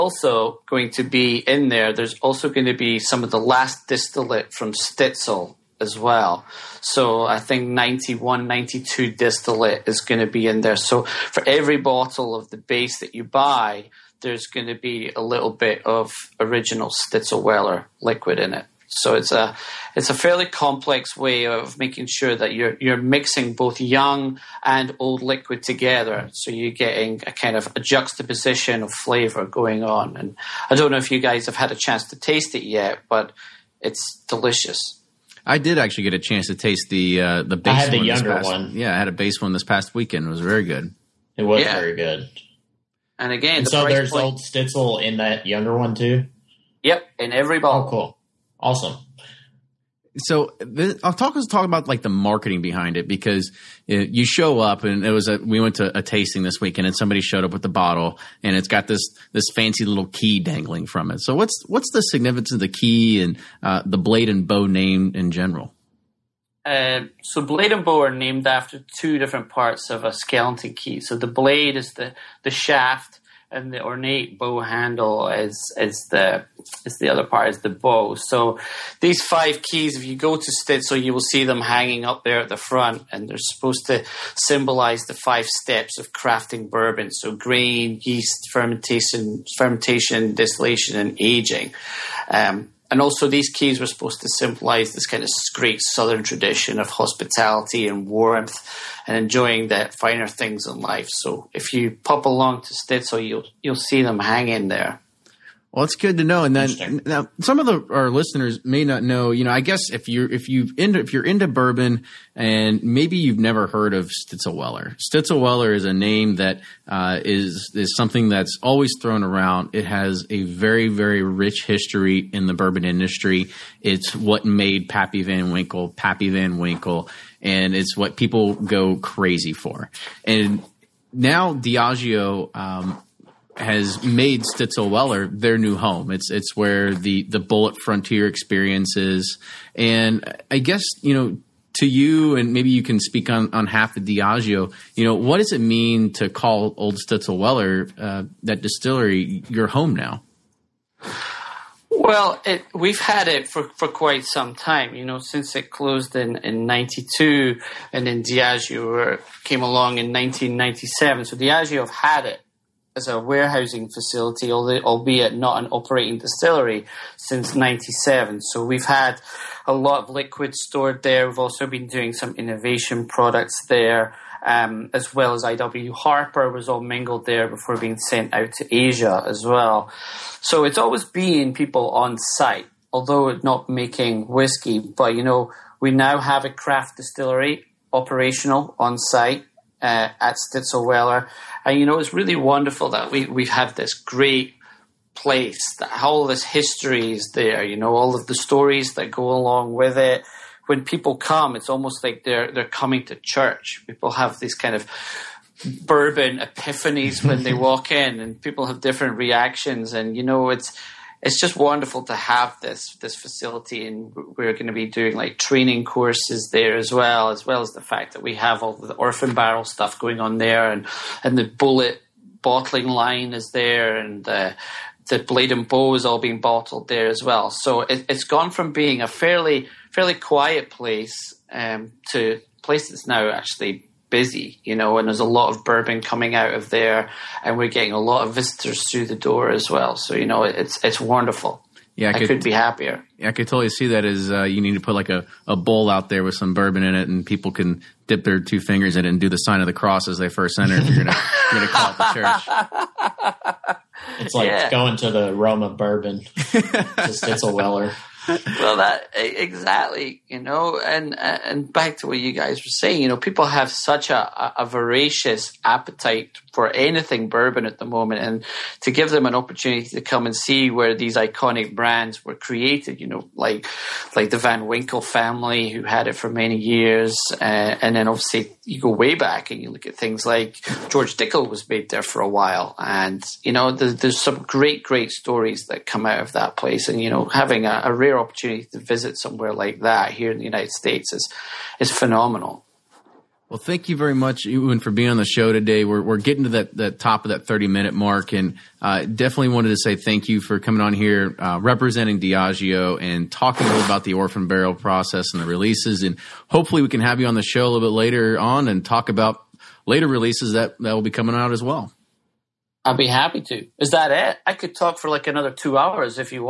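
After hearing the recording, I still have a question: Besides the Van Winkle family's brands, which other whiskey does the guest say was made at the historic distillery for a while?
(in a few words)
George Dickel.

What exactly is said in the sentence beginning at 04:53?
Well, thank you very much, Ewan, for being on the show today.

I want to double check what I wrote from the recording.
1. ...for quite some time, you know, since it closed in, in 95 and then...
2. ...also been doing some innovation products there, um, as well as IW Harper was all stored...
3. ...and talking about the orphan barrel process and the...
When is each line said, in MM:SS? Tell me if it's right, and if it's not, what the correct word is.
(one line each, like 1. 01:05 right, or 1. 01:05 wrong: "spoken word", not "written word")
1. 02:33 wrong: "92", not "95"
2. 02:51 wrong: "mingled", not "stored"
3. 05:02 right.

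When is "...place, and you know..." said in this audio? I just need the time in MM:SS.
04:46.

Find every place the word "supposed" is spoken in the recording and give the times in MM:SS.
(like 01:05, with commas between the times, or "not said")
01:23, 01:33.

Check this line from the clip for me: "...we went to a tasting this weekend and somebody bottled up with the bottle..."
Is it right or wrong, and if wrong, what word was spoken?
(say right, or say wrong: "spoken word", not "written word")
wrong: "showed", not "bottled".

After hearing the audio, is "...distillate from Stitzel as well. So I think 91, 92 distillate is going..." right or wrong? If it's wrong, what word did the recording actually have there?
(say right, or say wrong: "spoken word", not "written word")
right.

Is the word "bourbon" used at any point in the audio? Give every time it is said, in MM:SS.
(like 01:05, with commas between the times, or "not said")
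01:26, 01:51, 02:02, 03:25, 03:55, 04:06, 04:15, 04:27.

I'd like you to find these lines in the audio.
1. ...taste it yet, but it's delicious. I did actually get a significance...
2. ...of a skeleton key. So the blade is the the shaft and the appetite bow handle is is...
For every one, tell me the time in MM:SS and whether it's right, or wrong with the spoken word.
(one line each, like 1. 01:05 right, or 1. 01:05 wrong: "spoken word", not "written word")
1. 00:32 wrong: "chance", not "significance"
2. 01:09 wrong: "ornate", not "appetite".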